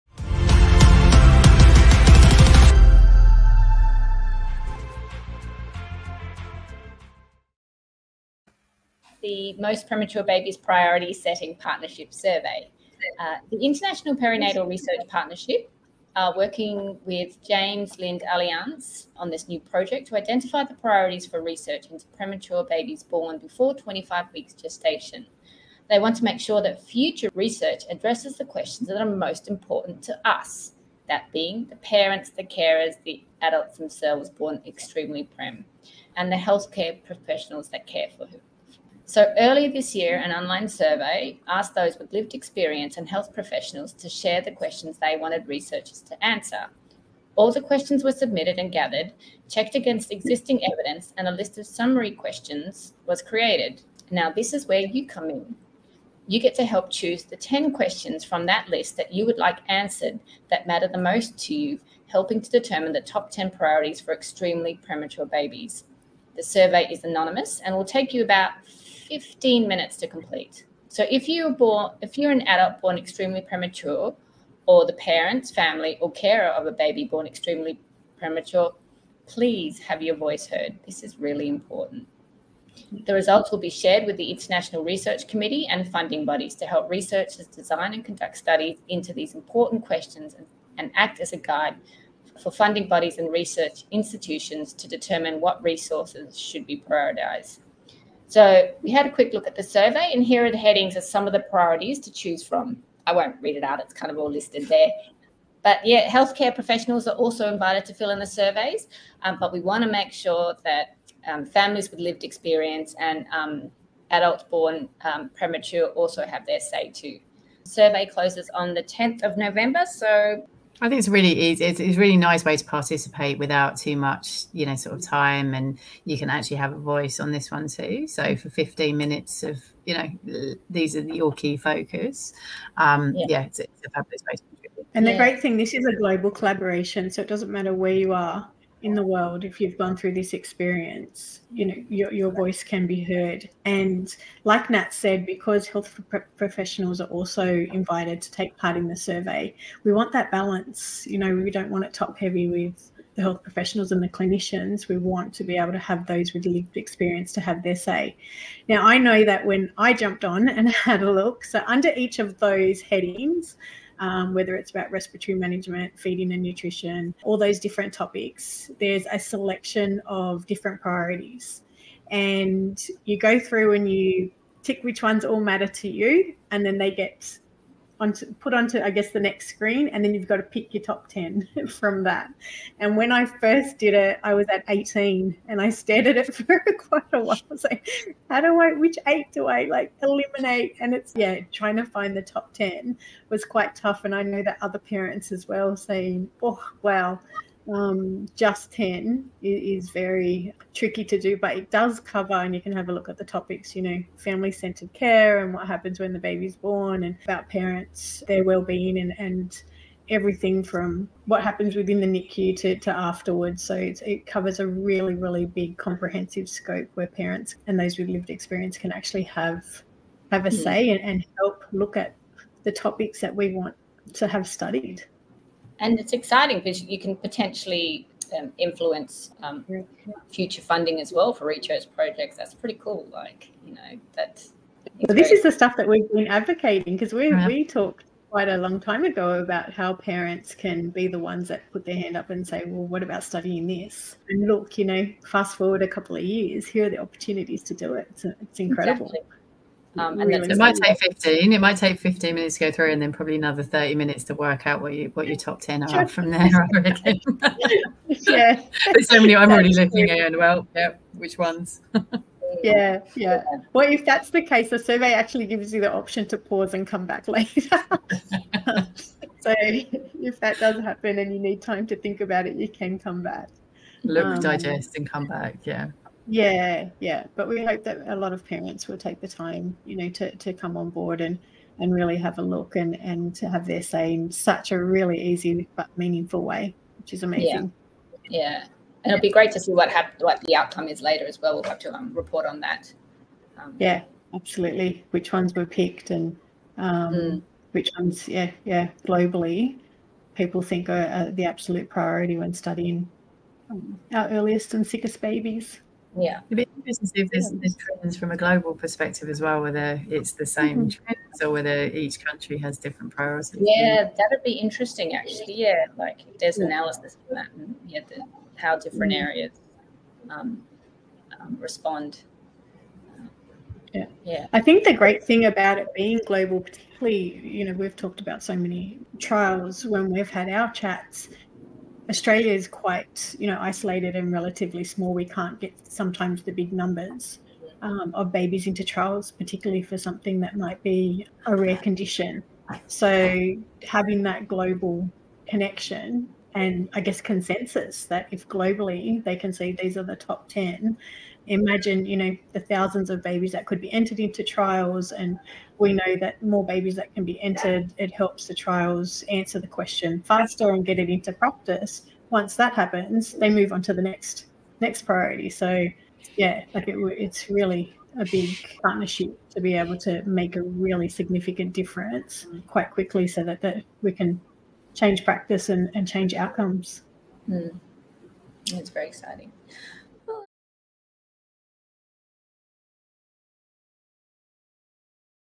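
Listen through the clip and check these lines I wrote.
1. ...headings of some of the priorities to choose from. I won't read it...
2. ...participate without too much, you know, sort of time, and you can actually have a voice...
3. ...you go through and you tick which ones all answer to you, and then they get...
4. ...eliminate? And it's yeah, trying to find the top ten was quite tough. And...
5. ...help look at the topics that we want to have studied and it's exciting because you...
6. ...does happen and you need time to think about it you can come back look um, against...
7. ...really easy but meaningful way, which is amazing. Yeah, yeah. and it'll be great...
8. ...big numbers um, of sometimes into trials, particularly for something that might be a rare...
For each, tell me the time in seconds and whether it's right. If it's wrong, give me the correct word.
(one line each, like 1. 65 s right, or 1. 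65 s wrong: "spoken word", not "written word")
1. 100 s right
2. 122 s right
3. 173 s wrong: "matter", not "answer"
4. 190 s right
5. 221 s right
6. 270 s wrong: "digest", not "against"
7. 284 s right
8. 336 s wrong: "babies", not "sometimes".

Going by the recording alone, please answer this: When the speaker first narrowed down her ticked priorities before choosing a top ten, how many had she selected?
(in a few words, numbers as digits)
18.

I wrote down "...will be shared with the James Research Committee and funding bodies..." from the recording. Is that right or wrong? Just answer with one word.
wrong.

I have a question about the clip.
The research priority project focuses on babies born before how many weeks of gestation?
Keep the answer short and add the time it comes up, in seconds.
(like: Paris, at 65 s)
25 weeks, at 23 s.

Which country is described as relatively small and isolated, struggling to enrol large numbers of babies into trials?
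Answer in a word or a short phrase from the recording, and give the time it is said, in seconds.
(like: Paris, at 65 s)
Australia, at 332 s.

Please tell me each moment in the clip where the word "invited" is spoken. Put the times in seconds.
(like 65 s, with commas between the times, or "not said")
107 s, 147 s.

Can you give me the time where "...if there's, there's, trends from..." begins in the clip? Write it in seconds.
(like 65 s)
307 s.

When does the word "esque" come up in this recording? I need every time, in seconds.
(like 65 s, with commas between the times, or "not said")
not said.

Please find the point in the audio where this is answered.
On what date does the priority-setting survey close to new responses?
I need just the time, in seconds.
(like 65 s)
118 s.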